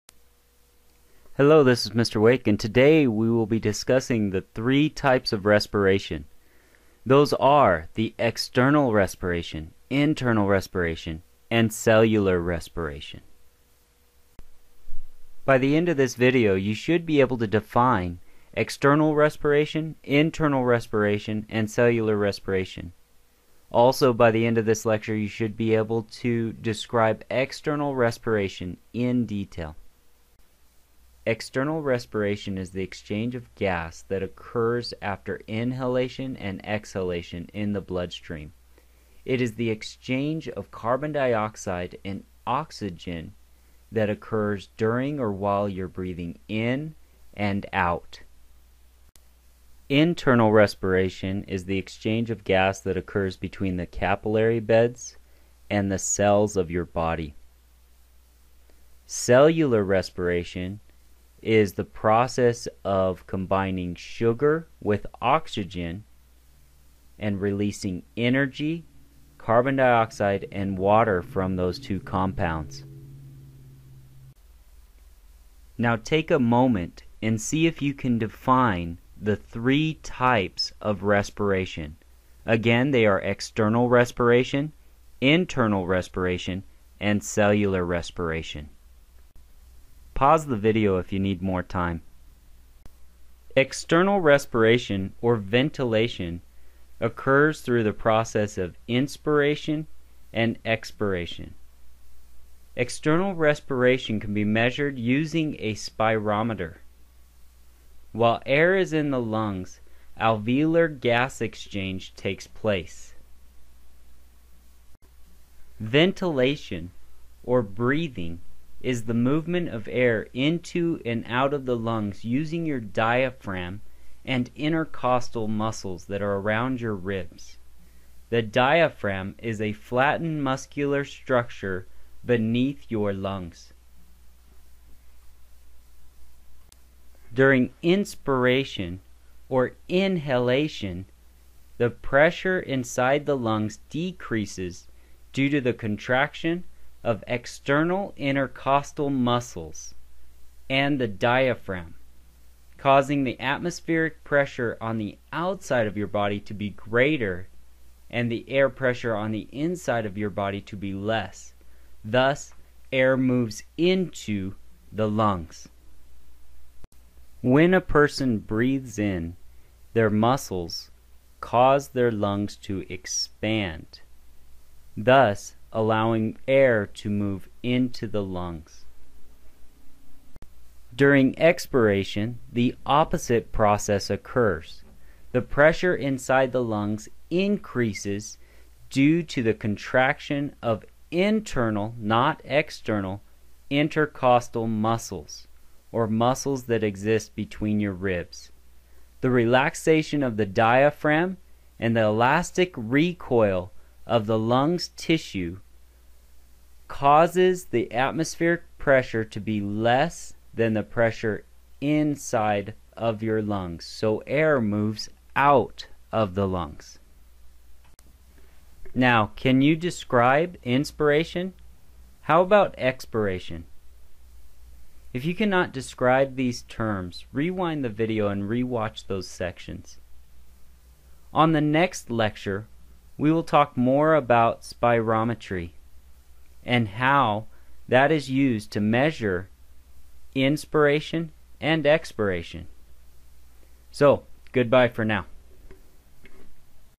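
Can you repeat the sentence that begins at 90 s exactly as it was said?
Pause the video if you need more time.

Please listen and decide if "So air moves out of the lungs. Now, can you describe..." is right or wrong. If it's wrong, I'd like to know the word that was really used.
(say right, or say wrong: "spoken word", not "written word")
right.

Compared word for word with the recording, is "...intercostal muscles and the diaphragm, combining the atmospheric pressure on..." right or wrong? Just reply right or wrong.
wrong.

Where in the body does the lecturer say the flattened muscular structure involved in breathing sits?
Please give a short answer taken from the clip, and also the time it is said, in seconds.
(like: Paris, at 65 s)
beneath your lungs, at 132 s.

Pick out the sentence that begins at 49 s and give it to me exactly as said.
Internal respiration is the exchange of gas that occurs between the capillary beds and the cells of your body.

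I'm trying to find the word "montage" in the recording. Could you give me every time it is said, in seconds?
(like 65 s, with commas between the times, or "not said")
not said.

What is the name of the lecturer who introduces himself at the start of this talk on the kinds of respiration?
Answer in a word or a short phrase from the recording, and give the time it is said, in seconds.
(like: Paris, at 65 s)
Mr. Wake, at 1 s.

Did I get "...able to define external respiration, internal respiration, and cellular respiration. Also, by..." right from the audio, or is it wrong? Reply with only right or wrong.
right.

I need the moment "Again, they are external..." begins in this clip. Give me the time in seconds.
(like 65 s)
82 s.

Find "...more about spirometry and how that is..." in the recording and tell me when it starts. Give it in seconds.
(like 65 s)
233 s.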